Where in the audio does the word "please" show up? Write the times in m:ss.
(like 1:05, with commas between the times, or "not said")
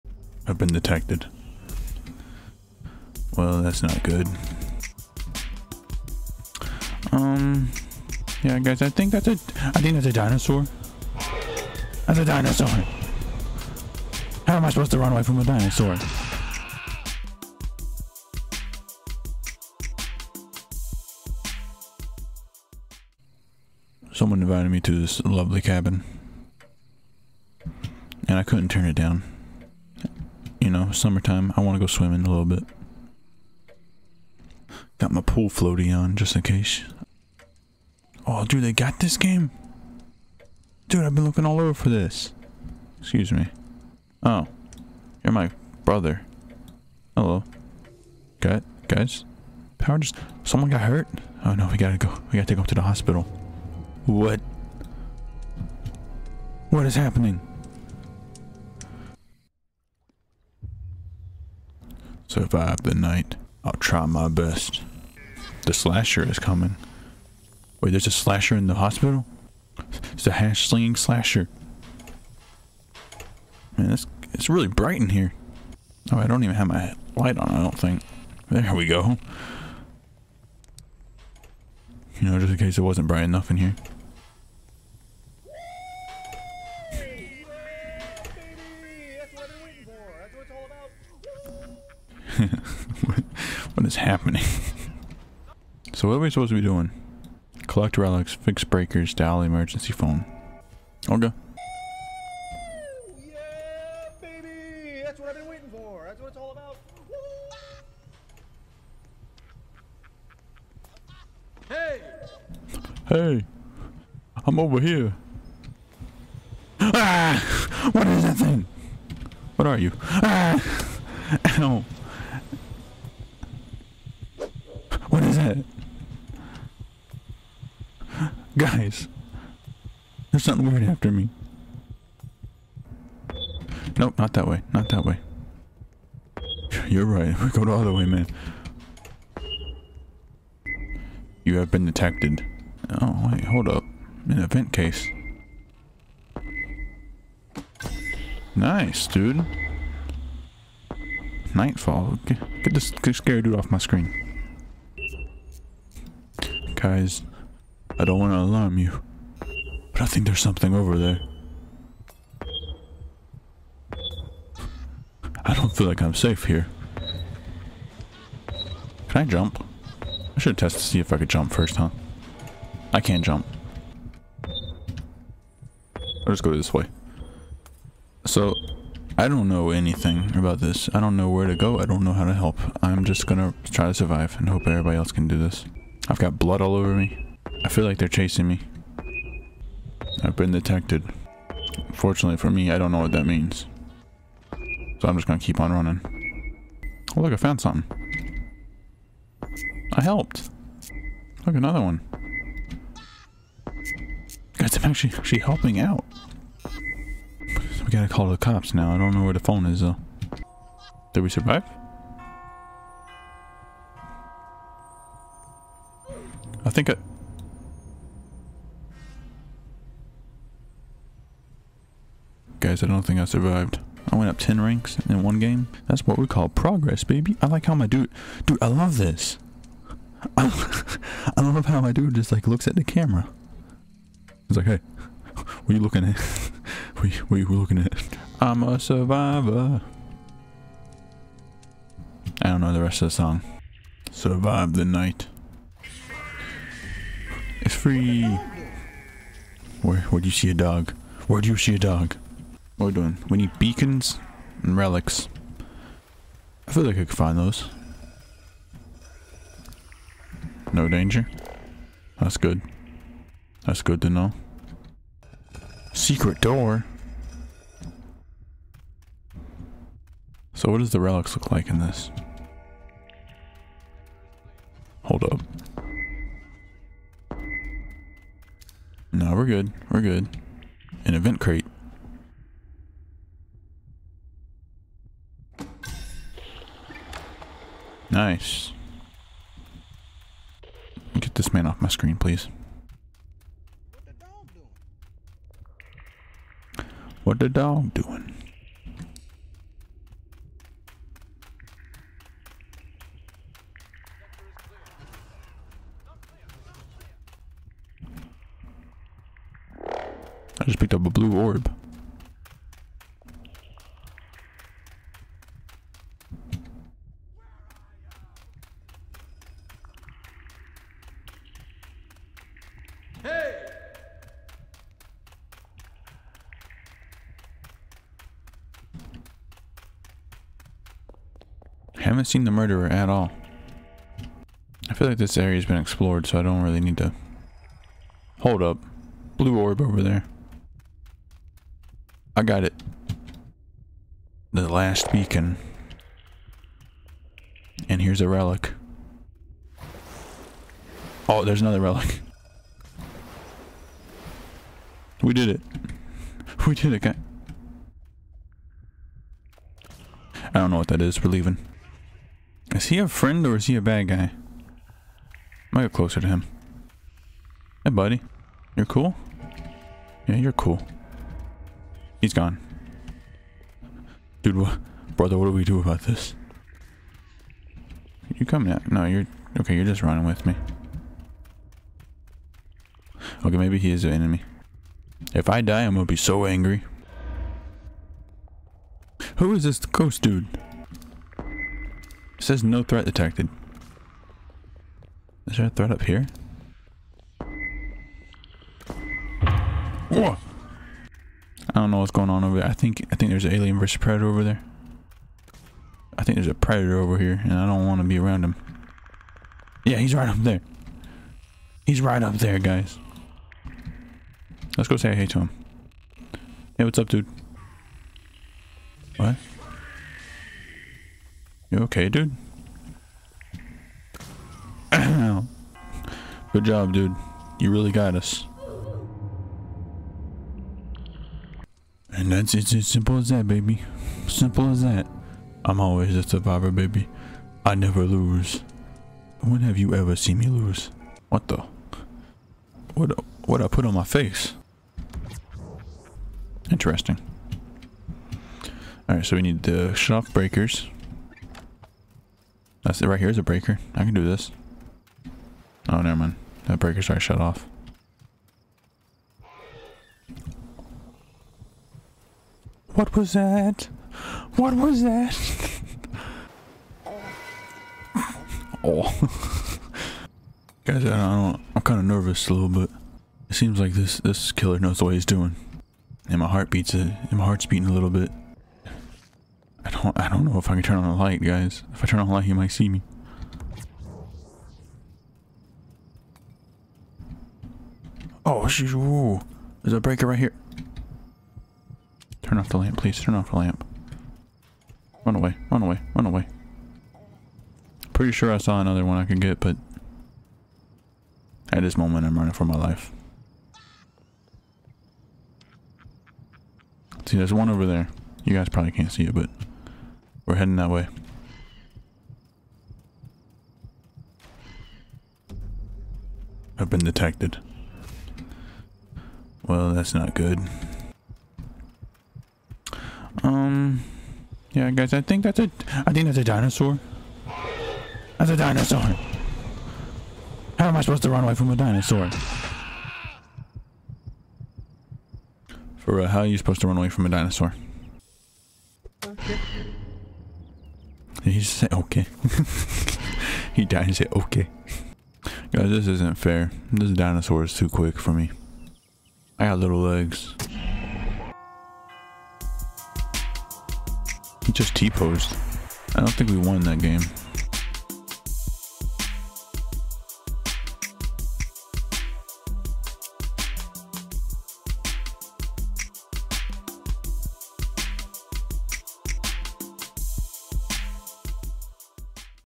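4:52, 8:12.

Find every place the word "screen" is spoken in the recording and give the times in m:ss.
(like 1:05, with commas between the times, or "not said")
2:33, 4:51.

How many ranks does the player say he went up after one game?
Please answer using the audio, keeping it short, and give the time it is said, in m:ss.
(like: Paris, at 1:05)
10, at 3:44.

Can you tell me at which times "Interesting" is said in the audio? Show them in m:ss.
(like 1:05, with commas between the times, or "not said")
7:26.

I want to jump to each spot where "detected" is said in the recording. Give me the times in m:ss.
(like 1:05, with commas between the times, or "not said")
0:00, 2:21, 3:10, 6:33, 8:36.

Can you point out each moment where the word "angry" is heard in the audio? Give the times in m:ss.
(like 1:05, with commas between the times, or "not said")
6:26.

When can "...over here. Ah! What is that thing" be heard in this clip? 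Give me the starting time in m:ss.
1:54.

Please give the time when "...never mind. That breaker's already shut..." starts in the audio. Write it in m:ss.
7:36.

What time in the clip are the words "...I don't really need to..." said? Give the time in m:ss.
5:36.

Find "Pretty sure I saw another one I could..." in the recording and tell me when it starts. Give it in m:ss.
8:18.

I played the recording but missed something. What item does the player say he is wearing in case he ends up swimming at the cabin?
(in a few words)
pool floaty.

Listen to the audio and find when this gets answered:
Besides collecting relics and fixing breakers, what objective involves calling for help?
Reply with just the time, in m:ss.
1:39.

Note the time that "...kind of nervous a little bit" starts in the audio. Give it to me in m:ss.
7:51.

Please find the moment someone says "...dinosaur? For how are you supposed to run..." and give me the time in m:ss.
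8:51.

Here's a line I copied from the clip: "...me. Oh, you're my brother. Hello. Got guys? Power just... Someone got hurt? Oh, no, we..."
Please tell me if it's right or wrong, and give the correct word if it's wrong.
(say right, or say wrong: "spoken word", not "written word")
right.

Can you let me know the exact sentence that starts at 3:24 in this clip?
Guys, I'm actually, actually helping out.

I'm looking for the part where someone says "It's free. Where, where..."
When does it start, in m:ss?
4:07.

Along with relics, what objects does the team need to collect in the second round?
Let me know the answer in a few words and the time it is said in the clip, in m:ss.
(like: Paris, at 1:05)
beacons, at 4:13.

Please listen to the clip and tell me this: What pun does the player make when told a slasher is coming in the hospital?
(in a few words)
hash slinging slasher.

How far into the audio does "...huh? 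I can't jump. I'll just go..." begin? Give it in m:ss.
2:51.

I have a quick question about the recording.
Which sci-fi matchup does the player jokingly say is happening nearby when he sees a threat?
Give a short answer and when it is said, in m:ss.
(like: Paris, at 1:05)
alien versus predator, at 6:43.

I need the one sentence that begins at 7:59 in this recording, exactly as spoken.
I don't I don't know if I can turn on the light, guys.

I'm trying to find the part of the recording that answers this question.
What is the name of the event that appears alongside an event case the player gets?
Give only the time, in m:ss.
2:31.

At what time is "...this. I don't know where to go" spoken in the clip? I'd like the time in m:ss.
3:00.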